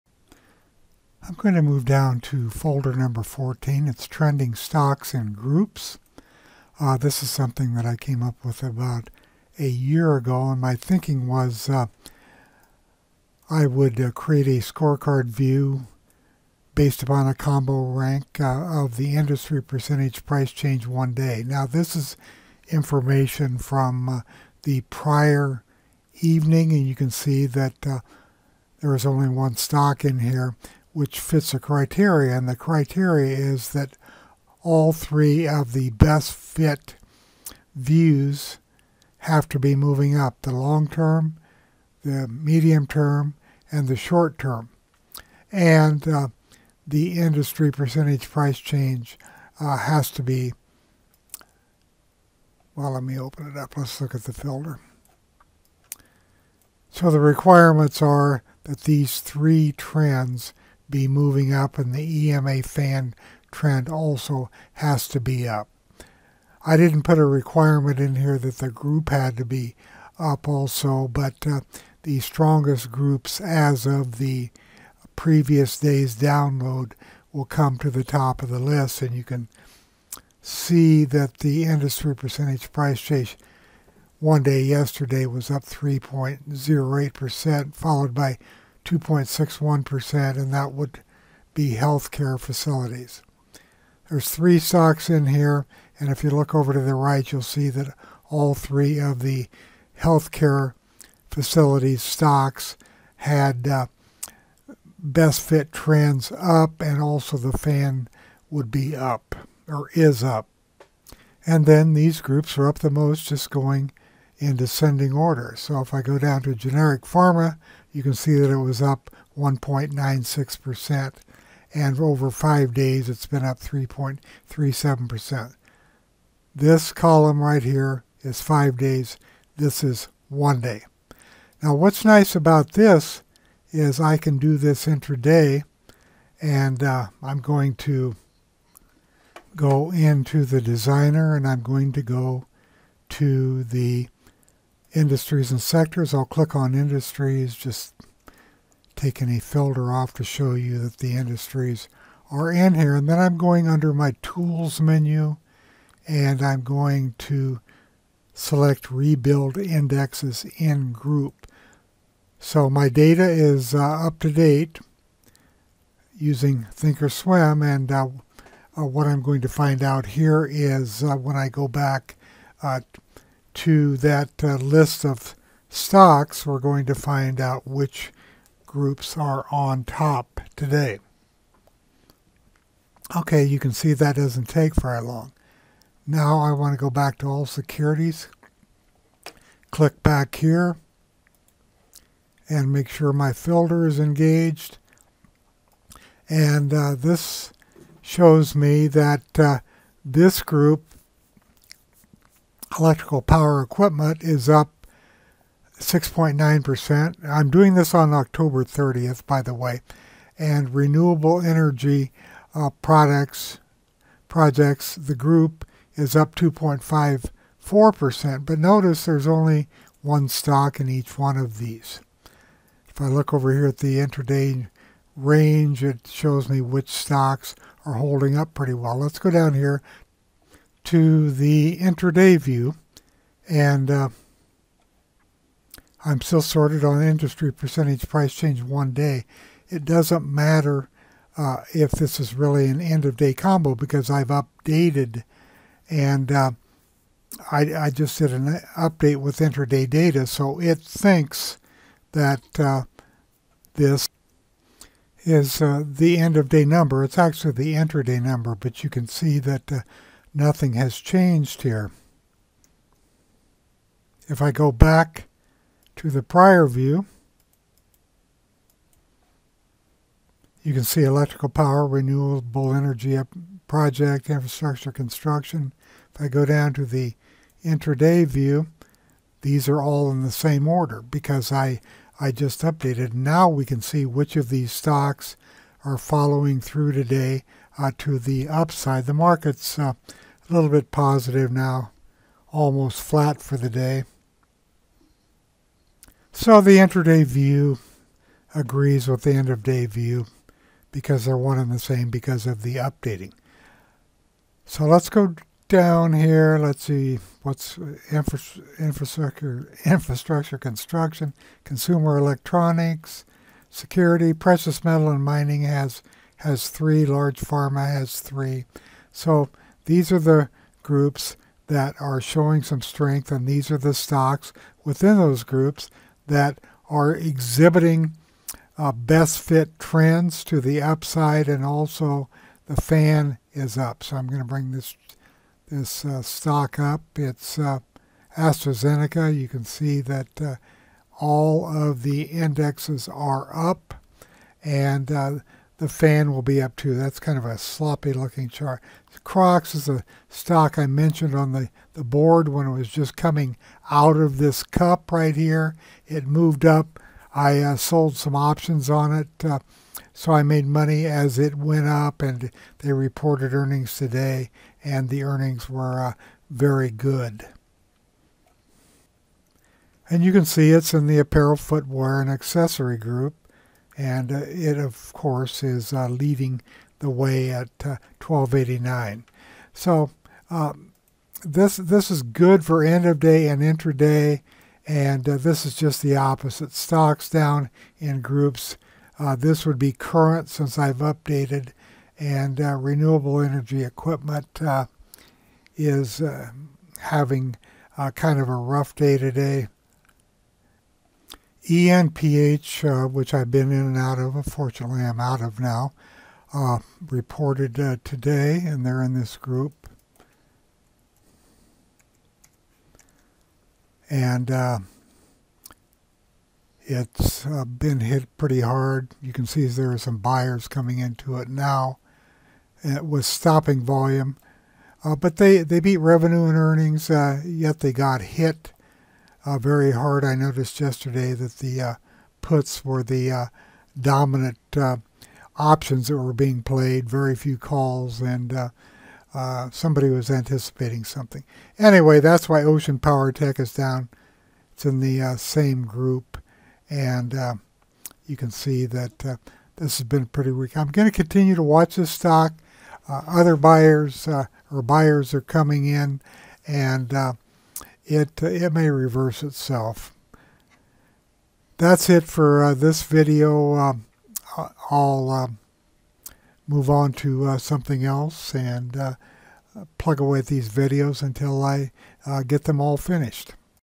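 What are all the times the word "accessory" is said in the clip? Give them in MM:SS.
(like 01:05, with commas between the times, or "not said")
06:12.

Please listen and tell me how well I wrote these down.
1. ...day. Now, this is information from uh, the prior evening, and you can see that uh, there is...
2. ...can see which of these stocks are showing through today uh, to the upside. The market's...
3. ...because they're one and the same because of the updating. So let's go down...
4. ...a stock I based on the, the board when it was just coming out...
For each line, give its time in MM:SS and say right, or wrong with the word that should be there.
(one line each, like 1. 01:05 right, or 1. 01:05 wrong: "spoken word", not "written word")
1. 00:21 right
2. 04:43 wrong: "following", not "showing"
3. 05:00 right
4. 05:49 wrong: "mentioned", not "based".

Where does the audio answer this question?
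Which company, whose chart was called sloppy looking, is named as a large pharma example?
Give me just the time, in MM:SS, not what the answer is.
05:38.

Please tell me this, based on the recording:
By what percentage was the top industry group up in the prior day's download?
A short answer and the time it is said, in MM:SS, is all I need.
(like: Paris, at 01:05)
3.08%, at 01:25.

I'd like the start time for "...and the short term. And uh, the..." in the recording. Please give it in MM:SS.
00:43.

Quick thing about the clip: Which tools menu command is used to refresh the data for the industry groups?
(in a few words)
Rebuild indexes in group.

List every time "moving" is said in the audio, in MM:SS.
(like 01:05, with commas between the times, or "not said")
00:39, 01:01.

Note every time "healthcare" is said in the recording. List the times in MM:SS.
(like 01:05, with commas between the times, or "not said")
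01:31, 01:39.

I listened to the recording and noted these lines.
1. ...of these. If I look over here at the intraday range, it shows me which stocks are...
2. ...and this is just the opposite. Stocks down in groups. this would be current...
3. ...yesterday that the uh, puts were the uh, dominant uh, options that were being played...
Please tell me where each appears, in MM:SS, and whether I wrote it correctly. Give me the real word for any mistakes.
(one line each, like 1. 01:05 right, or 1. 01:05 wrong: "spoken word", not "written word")
1. 03:41 right
2. 06:24 right
3. 07:10 right.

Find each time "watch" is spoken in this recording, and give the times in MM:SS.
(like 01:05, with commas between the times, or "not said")
07:31.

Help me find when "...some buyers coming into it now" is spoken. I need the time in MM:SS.
06:59.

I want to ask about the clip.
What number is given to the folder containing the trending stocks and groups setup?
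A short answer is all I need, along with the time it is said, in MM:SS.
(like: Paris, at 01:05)
14, at 00:03.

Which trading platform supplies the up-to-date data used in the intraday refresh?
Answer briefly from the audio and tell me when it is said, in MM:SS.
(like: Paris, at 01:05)
thinkorswim, at 02:46.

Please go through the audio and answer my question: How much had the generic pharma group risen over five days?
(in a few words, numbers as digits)
3.37%.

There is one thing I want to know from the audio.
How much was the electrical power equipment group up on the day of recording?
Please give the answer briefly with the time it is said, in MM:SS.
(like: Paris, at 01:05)
6.9%, at 03:25.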